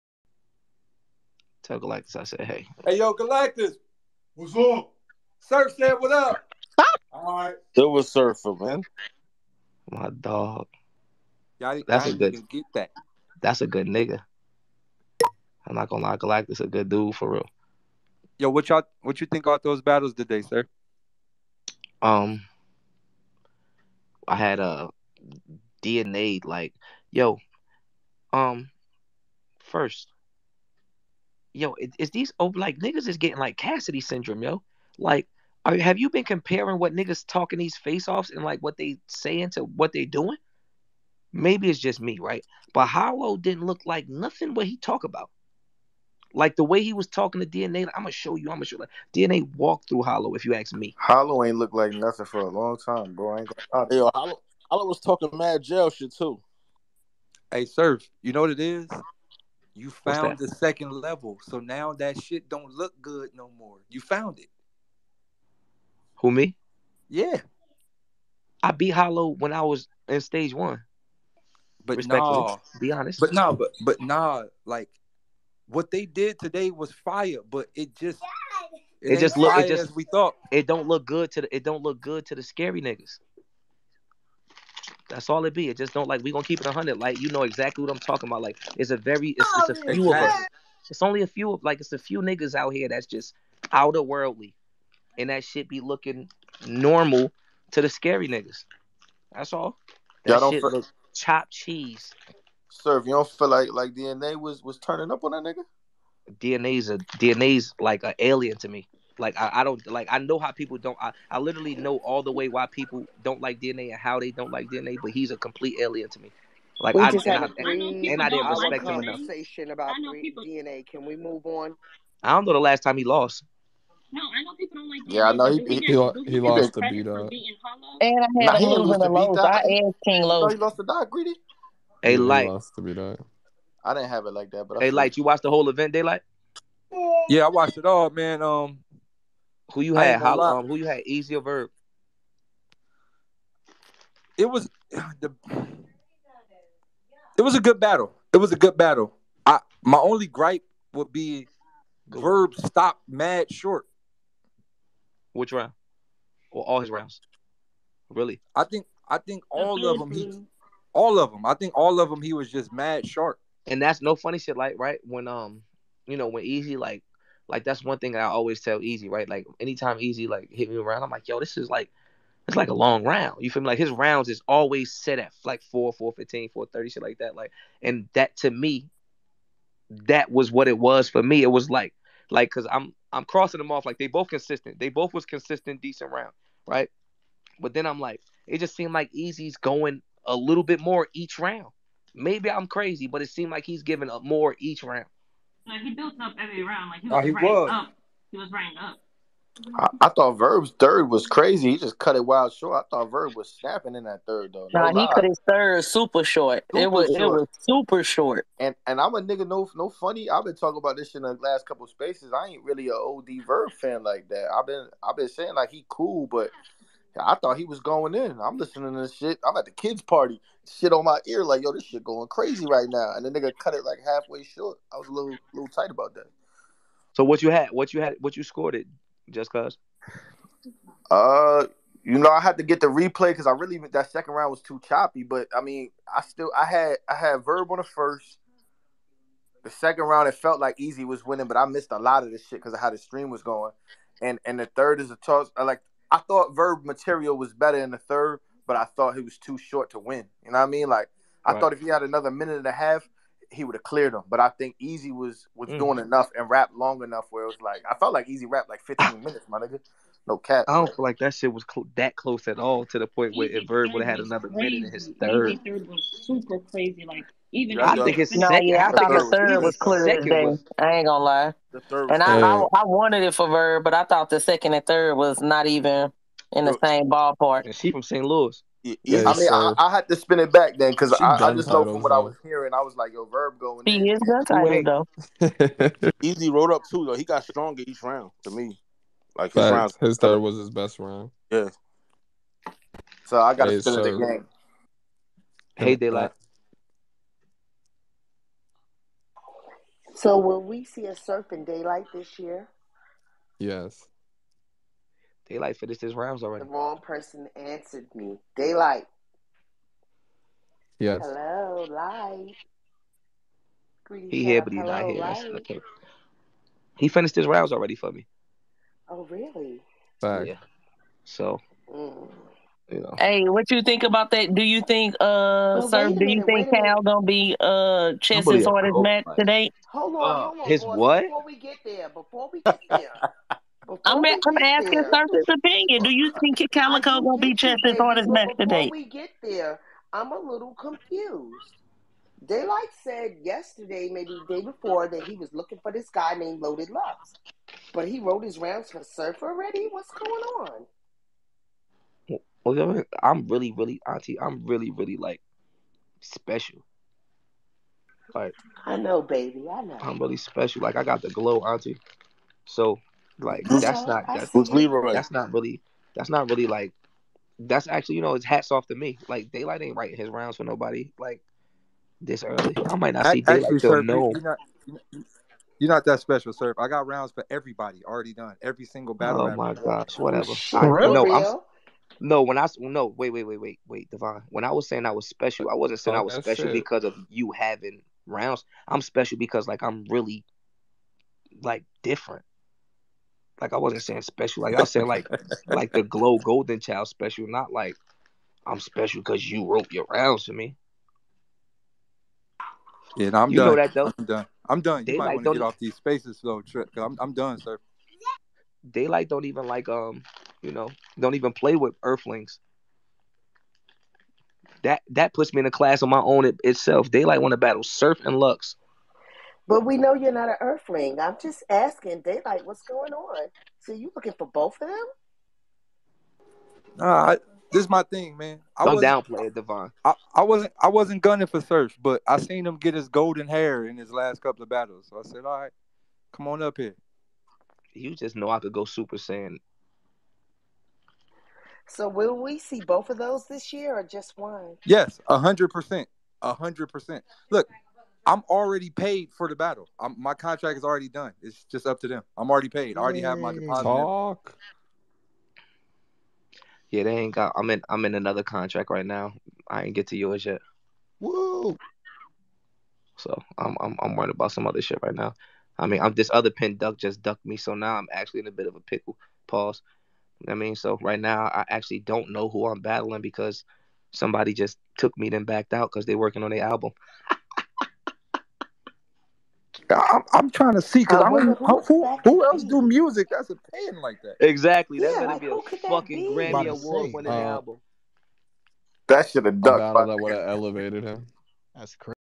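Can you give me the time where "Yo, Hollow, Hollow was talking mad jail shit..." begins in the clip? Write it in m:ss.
0:53.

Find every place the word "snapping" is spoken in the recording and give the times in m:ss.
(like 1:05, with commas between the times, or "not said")
3:23.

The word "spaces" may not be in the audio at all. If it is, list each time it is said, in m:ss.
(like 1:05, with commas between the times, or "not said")
3:31, 6:45.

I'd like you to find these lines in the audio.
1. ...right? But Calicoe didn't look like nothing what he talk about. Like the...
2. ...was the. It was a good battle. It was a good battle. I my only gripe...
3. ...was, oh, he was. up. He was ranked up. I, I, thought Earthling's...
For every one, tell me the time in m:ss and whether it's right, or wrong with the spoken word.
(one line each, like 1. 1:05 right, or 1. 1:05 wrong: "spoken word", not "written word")
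1. 0:42 wrong: "Hollow", not "Calicoe"
2. 2:24 right
3. 3:17 wrong: "Verb", not "Earthling".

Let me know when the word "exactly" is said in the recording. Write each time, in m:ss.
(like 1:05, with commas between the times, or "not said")
1:27, 8:04.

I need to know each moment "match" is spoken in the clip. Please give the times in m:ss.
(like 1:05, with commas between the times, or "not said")
5:28, 5:38.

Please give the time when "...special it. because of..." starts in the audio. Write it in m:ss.
6:26.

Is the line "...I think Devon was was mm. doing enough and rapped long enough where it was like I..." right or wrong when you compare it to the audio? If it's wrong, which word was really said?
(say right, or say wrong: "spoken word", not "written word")
wrong: "Easy", not "Devon".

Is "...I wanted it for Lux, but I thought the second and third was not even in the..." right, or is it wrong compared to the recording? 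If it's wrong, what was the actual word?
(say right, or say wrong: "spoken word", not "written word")
wrong: "Verb", not "Lux".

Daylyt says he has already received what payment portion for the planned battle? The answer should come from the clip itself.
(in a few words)
Deposit.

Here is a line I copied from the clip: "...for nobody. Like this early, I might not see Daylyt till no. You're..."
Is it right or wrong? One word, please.
right.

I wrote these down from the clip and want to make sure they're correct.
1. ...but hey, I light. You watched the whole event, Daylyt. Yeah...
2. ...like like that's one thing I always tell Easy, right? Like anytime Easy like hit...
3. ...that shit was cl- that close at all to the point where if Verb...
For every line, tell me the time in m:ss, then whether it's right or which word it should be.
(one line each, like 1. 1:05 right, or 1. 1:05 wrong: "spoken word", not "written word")
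1. 2:14 right
2. 2:46 right
3. 4:21 right.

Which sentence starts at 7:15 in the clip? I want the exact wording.
So I said, all right, come on up here.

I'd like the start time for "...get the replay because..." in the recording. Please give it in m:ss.
3:52.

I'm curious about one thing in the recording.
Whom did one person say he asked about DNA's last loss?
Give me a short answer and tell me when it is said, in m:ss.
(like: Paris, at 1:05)
King Lowe, at 2:10.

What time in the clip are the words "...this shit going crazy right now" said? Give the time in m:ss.
3:41.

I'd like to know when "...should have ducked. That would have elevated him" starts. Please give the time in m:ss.
8:09.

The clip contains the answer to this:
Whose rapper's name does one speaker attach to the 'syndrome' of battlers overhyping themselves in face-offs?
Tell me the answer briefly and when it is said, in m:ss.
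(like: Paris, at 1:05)
Cassidy, at 0:33.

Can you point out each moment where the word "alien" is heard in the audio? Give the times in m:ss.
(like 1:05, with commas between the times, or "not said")
1:48, 1:55.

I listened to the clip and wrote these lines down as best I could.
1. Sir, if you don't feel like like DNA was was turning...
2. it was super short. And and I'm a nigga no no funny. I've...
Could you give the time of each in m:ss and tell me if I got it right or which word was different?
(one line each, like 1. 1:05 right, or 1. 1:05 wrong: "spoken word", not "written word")
1. 1:42 right
2. 3:27 right.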